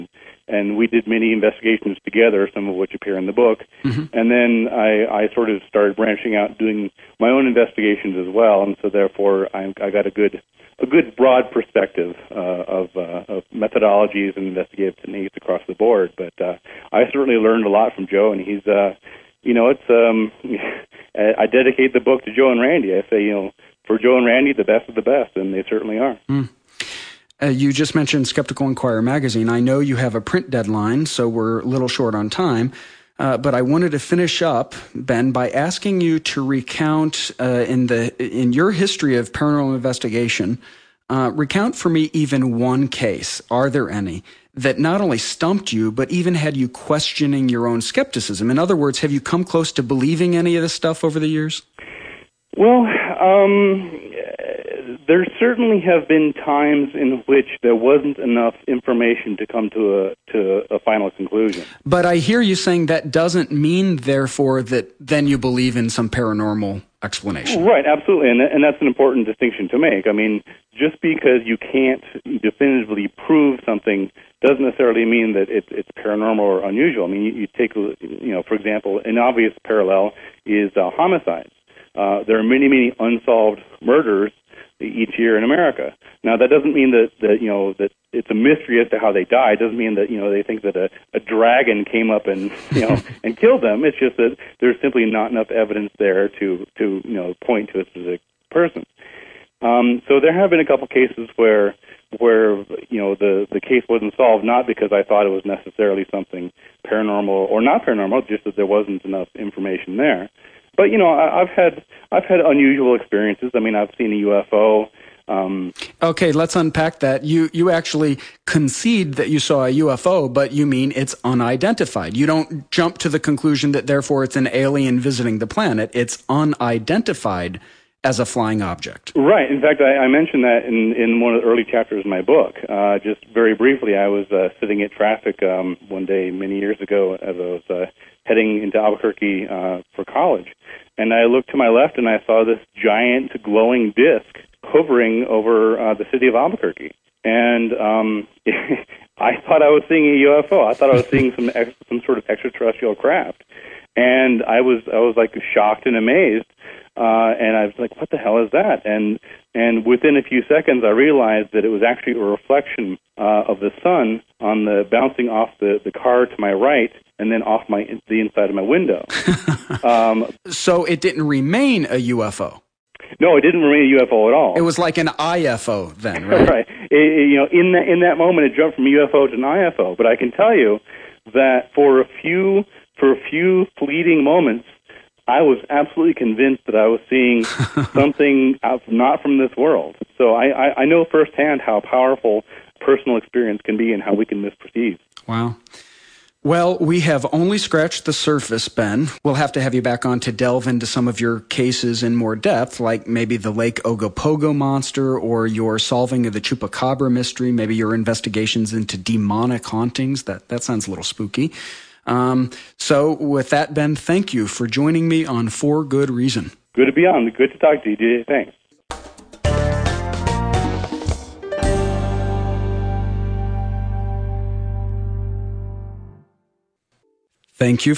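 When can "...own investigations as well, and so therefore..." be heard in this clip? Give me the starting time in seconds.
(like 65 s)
7 s.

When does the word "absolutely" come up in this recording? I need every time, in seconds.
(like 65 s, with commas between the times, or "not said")
67 s, 185 s.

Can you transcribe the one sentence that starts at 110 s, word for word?
But you know, I, I've had I've had unusual experiences.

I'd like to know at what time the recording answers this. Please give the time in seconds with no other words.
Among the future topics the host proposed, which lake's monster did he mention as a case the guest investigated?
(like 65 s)
203 s.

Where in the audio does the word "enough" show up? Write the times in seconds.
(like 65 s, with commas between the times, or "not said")
58 s, 95 s, 109 s.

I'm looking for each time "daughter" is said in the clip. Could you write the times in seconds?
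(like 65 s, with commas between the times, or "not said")
not said.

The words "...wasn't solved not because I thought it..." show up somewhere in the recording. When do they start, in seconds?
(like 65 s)
103 s.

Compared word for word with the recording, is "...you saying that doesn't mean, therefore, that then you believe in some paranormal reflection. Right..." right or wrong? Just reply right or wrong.
wrong.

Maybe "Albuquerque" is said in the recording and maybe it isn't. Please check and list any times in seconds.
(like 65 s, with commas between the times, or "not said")
138 s, 146 s.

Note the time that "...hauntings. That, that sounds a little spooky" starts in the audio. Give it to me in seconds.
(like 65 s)
209 s.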